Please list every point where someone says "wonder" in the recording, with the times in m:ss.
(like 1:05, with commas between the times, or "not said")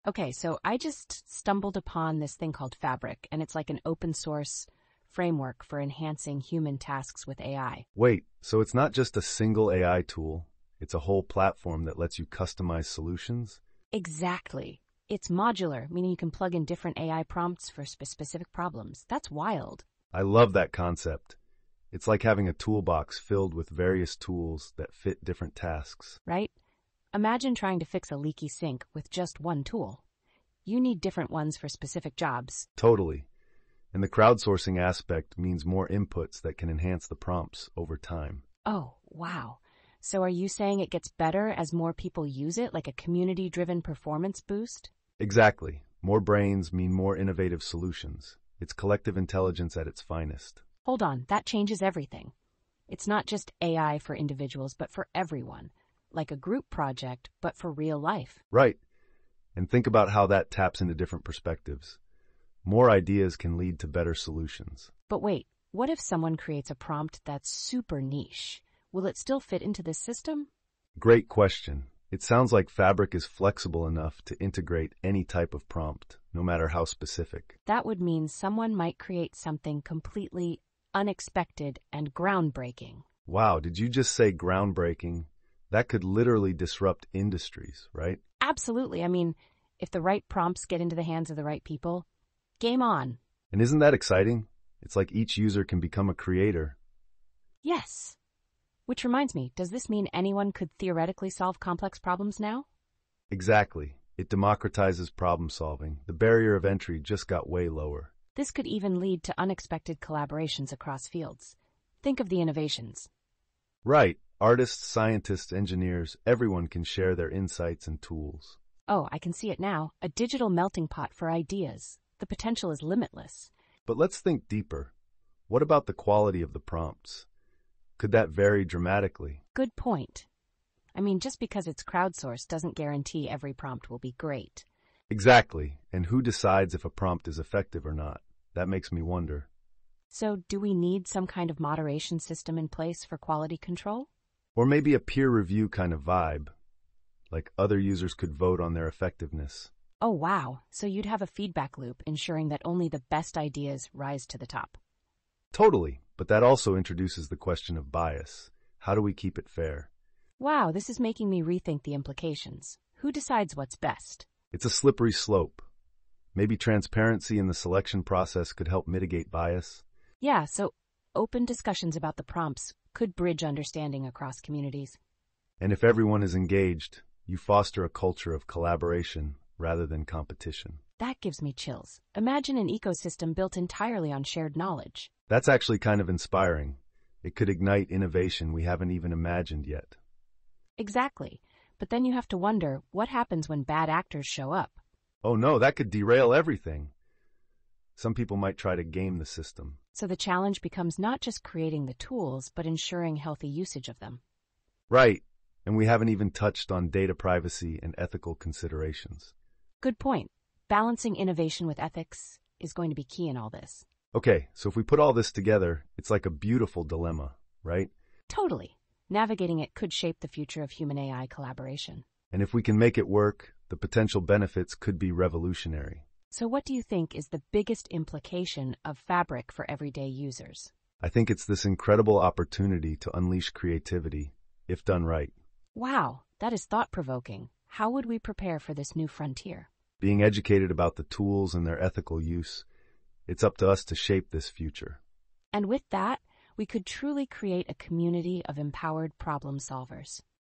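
2:19, 3:12.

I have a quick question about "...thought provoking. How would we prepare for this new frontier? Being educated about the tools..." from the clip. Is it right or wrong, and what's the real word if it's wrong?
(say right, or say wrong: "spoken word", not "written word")
right.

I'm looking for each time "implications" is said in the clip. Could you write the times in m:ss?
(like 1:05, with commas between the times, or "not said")
2:41, 3:47.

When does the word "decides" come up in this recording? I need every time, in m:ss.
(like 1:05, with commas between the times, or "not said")
2:16, 2:43.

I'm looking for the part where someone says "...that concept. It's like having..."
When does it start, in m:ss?
0:20.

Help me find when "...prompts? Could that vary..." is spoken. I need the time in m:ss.
2:06.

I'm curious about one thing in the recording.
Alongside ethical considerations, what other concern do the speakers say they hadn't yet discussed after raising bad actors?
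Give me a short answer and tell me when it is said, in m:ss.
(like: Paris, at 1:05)
data privacy, at 3:26.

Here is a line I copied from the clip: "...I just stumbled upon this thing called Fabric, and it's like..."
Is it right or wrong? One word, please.
right.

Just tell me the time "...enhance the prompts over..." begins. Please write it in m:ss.
0:36.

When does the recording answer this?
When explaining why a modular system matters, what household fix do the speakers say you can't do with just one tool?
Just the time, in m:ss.
0:28.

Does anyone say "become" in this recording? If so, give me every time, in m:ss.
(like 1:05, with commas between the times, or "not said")
1:35, 3:20.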